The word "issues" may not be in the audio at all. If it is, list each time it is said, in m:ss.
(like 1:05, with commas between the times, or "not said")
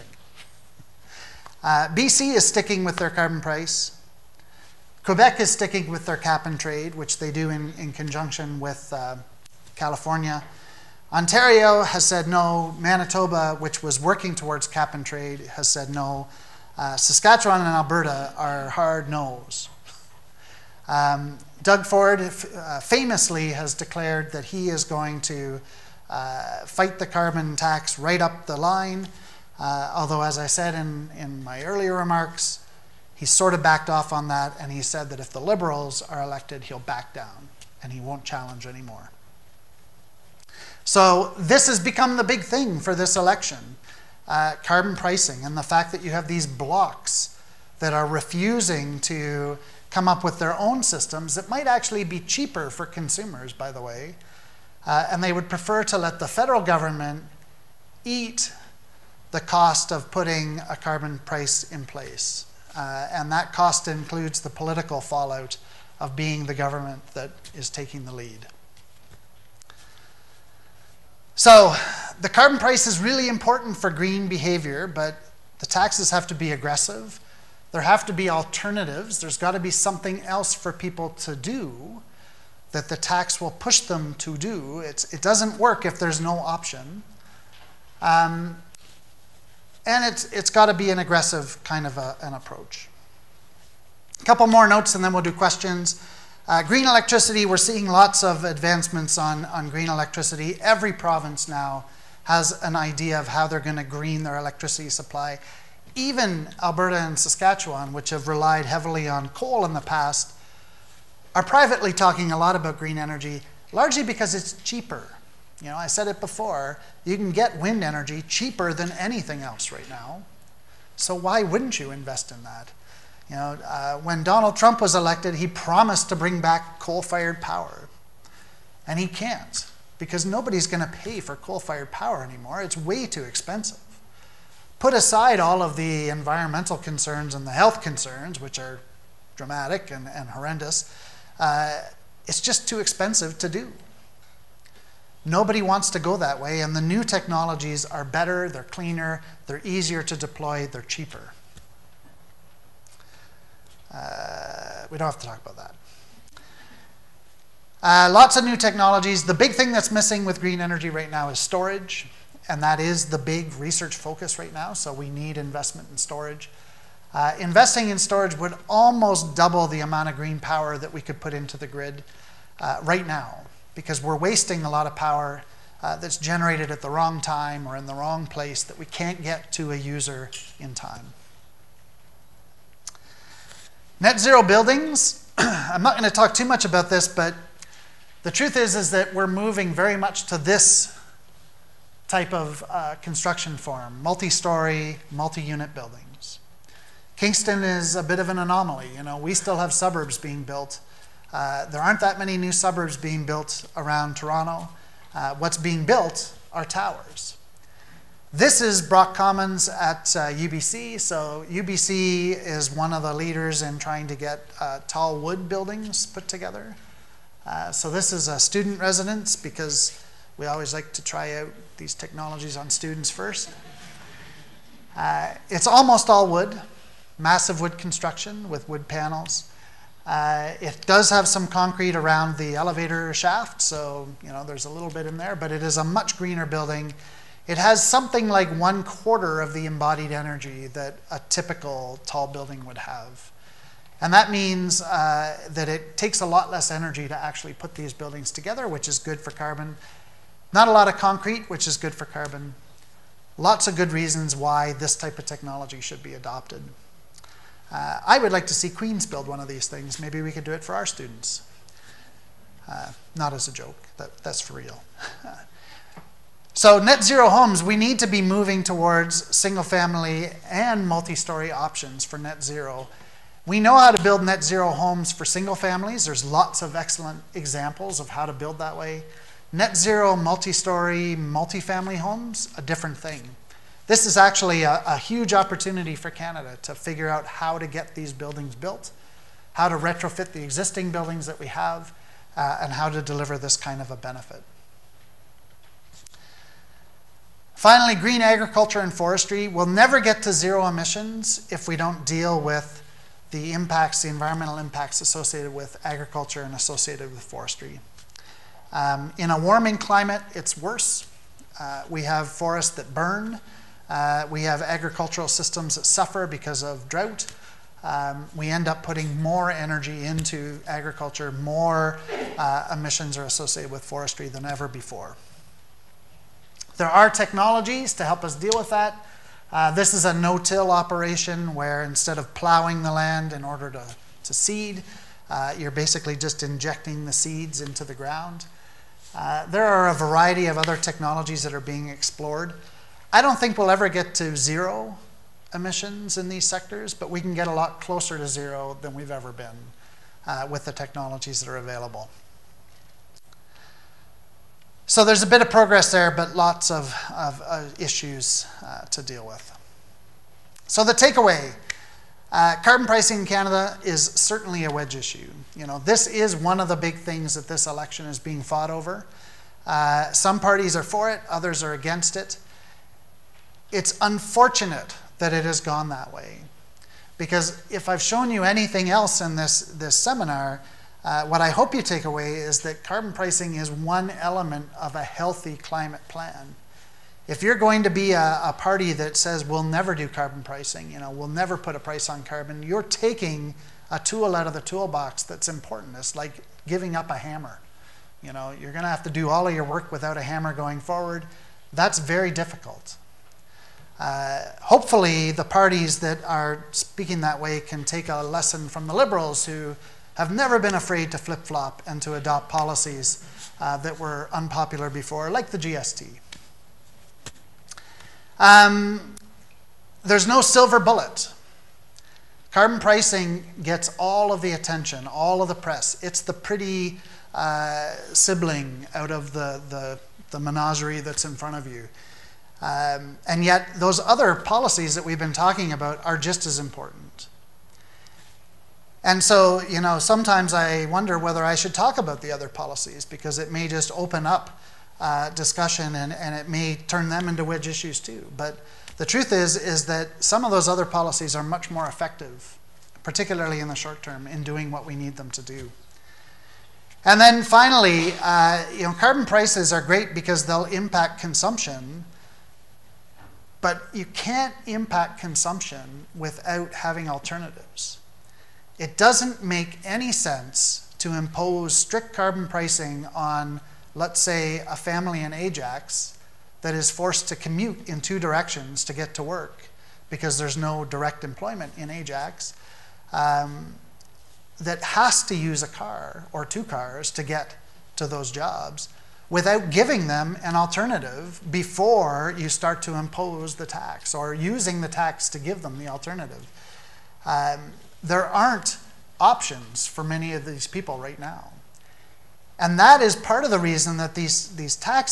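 5:57, 6:04, 7:27.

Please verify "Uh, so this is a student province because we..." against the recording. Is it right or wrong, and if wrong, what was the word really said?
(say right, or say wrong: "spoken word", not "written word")
wrong: "residence", not "province".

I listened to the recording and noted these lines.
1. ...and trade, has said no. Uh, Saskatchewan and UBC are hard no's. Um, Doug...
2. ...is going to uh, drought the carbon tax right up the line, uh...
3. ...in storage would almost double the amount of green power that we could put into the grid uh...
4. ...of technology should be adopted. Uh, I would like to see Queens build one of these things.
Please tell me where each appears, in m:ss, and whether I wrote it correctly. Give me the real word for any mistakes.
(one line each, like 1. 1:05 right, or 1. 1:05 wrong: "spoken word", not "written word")
1. 0:14 wrong: "Alberta", not "UBC"
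2. 0:24 wrong: "fight", not "drought"
3. 2:47 right
4. 4:15 right.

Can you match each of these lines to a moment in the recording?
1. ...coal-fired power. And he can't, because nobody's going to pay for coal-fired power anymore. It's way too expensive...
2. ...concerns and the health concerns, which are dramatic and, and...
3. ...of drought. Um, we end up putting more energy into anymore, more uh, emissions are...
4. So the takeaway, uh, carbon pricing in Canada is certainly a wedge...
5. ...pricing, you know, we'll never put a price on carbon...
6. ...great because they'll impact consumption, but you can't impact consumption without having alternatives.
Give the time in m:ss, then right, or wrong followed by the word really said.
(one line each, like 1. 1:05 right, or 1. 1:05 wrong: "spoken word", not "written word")
1. 2:06 right
2. 2:16 right
3. 5:16 wrong: "agriculture", not "anymore"
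4. 6:00 right
5. 6:30 right
6. 7:39 right.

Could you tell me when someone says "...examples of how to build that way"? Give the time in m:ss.
4:37.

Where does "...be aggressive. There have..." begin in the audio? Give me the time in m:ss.
1:16.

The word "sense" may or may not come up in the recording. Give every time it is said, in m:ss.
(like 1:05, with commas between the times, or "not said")
7:50.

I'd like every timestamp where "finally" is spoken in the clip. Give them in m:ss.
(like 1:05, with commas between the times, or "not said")
4:57, 7:37.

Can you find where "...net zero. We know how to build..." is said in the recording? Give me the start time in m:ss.
4:32.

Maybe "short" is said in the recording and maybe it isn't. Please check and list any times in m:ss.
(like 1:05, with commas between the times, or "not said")
7:33.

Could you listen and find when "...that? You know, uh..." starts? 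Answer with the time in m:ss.
2:02.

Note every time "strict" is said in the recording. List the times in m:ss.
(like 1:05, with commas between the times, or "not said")
7:51.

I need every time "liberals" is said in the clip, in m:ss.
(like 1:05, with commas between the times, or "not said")
0:35, 6:48.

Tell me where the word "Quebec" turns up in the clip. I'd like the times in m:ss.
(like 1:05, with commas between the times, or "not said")
0:05.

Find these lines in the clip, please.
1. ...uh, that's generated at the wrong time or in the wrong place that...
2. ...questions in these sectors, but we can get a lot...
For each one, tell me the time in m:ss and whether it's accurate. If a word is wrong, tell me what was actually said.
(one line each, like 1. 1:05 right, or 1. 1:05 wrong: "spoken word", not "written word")
1. 2:55 right
2. 5:45 wrong: "emissions", not "questions".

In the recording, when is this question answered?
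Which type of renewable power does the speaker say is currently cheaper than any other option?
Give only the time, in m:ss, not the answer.
1:57.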